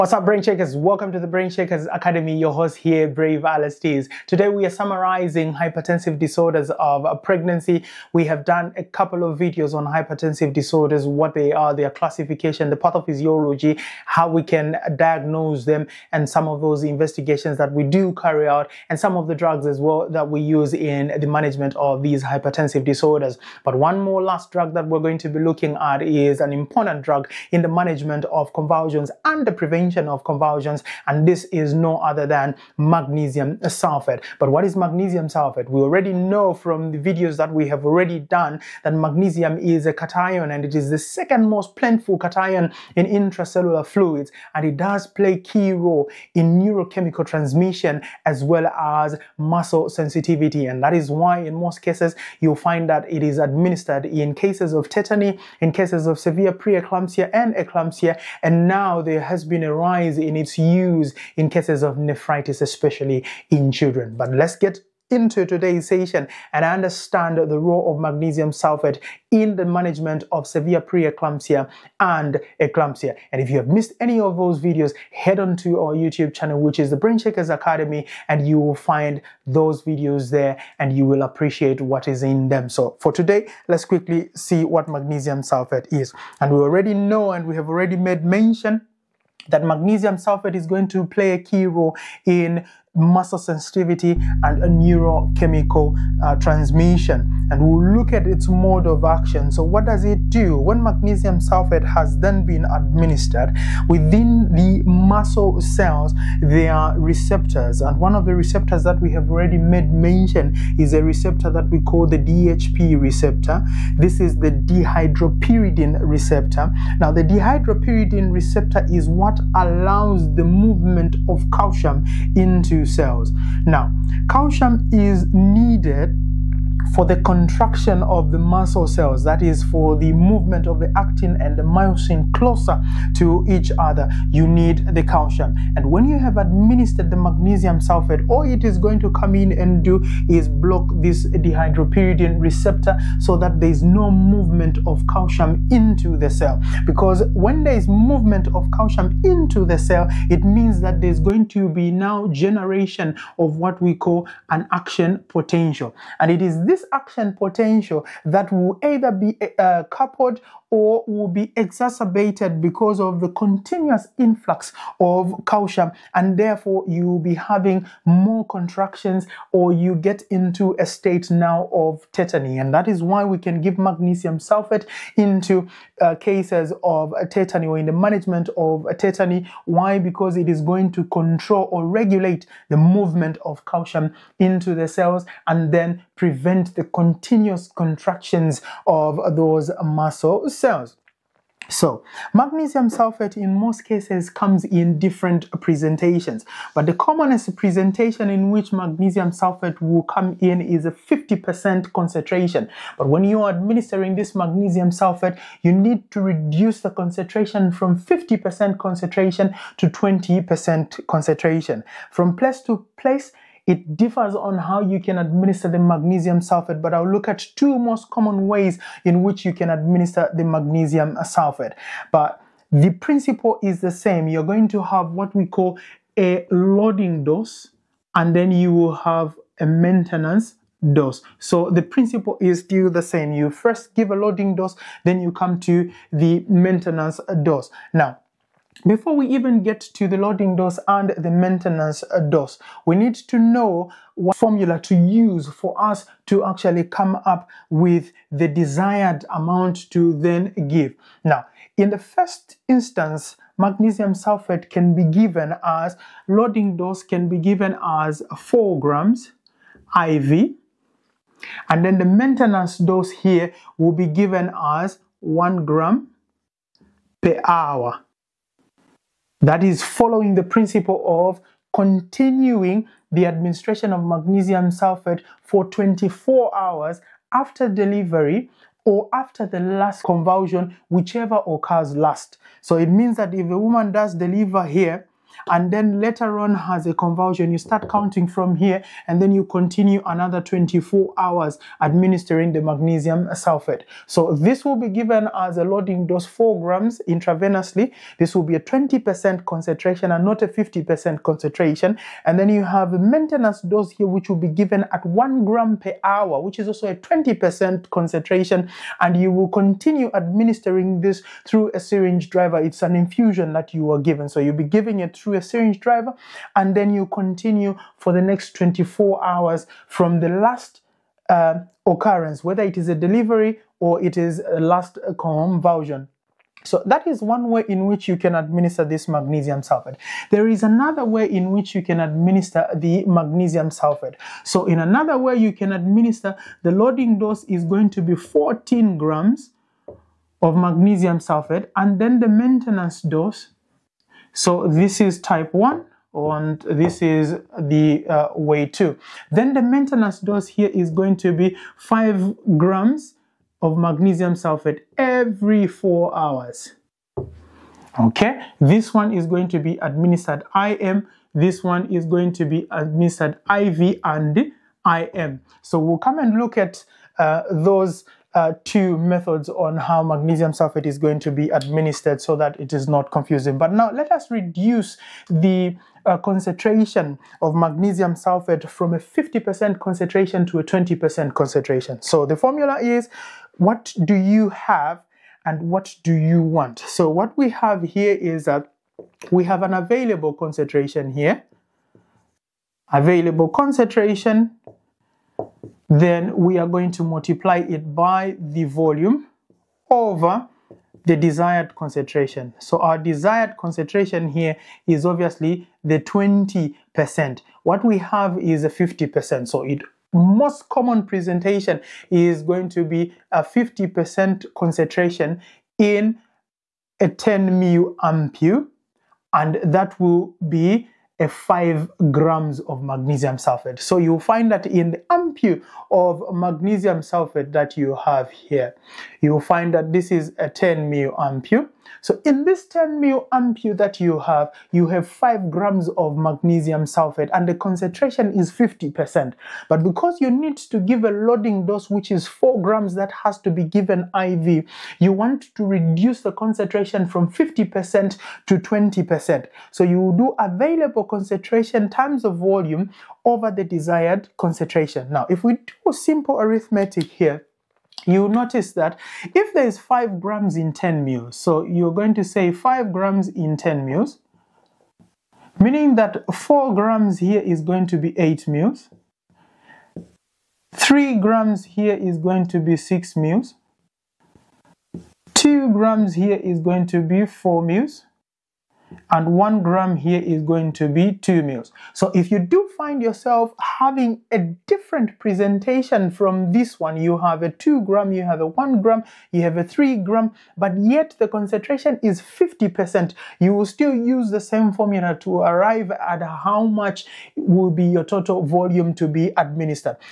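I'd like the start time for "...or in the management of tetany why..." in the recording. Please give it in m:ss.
2:57.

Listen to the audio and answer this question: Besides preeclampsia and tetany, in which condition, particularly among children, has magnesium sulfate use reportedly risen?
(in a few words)
nephritis.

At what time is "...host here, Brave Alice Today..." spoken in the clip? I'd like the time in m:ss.
0:02.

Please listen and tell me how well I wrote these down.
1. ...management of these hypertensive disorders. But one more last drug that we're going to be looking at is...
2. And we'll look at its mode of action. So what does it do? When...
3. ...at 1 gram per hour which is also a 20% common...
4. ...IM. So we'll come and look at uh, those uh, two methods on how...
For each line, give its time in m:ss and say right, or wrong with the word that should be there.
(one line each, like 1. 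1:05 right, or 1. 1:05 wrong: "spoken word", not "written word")
1. 0:21 right
2. 1:37 right
3. 5:04 wrong: "concentration", not "common"
4. 6:04 right.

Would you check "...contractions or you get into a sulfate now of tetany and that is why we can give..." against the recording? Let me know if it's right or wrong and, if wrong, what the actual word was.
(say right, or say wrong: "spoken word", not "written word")
wrong: "state", not "sulfate".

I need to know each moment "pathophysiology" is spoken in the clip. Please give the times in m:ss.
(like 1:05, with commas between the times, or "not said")
0:12.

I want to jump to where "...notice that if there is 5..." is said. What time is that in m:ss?
7:38.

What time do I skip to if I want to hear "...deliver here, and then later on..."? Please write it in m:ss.
4:44.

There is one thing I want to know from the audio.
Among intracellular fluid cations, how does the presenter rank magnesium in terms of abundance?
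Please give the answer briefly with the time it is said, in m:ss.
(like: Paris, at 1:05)
second most plentiful, at 0:40.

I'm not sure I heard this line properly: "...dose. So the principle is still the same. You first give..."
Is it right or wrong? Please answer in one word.
right.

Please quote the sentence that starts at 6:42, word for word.
So our desired concentration here is obviously the 20%.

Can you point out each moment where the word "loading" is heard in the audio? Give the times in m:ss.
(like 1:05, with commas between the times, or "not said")
3:46, 3:54, 4:00, 4:16, 4:55, 5:36, 7:21.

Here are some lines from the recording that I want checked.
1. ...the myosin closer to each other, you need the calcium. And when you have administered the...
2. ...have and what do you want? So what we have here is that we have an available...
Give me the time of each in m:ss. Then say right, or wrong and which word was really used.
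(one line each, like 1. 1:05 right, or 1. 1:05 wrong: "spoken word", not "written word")
1. 2:11 right
2. 6:24 right.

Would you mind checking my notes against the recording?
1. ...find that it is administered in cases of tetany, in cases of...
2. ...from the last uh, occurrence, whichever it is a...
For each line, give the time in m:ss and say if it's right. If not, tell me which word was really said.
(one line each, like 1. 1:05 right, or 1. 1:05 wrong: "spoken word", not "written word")
1. 0:52 right
2. 5:19 wrong: "whether", not "whichever".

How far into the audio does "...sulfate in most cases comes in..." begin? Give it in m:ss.
3:12.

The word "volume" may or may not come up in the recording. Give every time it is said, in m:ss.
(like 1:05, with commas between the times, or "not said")
6:38, 7:32, 8:18.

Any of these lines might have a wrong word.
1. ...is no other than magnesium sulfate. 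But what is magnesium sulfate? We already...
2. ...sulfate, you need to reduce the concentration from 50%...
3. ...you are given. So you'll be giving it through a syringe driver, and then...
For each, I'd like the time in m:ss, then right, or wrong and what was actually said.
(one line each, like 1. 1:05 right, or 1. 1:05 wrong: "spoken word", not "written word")
1. 0:31 right
2. 3:24 right
3. 5:13 right.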